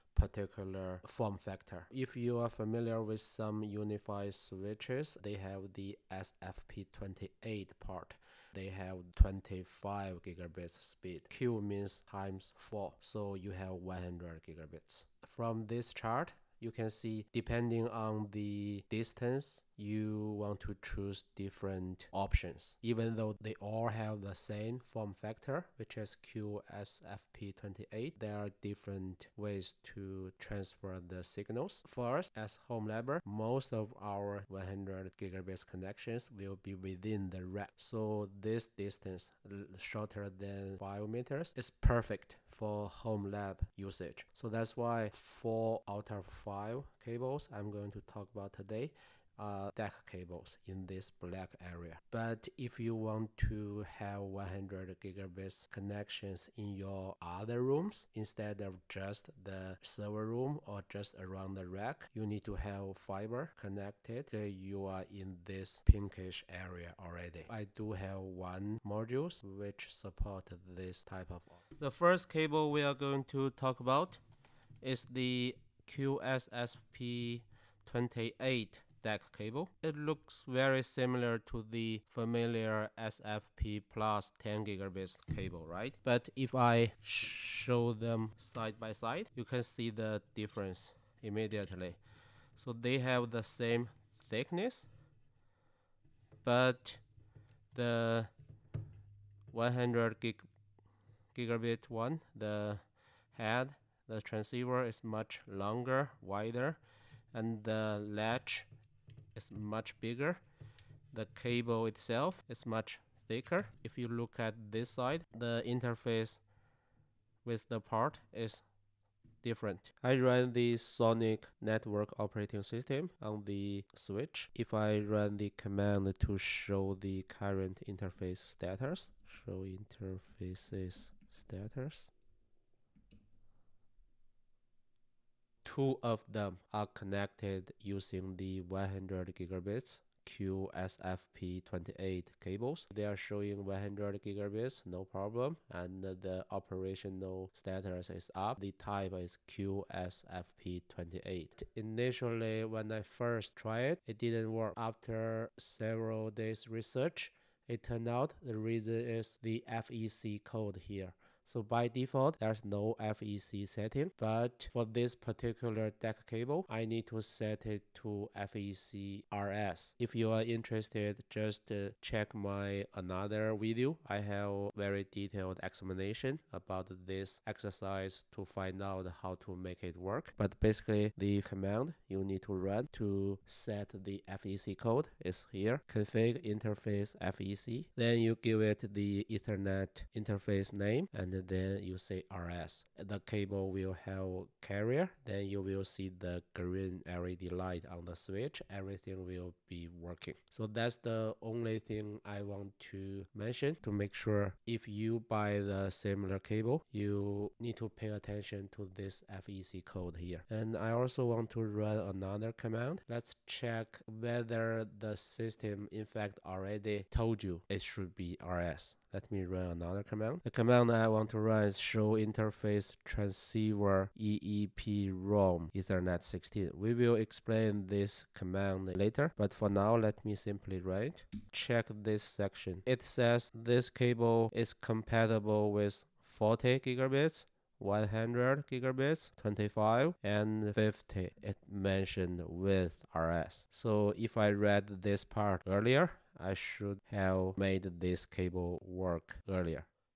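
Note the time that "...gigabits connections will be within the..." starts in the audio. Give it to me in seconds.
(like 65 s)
35 s.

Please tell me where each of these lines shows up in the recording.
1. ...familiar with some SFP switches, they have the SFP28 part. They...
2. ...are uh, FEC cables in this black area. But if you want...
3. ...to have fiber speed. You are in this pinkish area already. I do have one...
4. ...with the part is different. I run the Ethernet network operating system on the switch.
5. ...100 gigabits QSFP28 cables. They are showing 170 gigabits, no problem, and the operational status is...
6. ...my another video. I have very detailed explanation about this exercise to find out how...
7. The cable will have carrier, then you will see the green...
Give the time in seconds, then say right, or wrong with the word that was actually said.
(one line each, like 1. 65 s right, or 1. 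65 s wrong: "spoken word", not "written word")
1. 2 s wrong: "UniFi", not "SFP"
2. 49 s wrong: "DAC", not "FEC"
3. 62 s wrong: "connected", not "speed"
4. 117 s wrong: "SONiC", not "Ethernet"
5. 138 s wrong: "100", not "170"
6. 172 s right
7. 192 s right.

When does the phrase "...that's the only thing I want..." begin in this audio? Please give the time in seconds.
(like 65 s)
200 s.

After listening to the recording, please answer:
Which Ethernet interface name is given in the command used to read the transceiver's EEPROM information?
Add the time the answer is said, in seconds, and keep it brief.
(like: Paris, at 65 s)
Ethernet 16, at 225 s.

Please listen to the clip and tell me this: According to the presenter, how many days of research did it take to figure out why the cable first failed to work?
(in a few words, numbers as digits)
Several days.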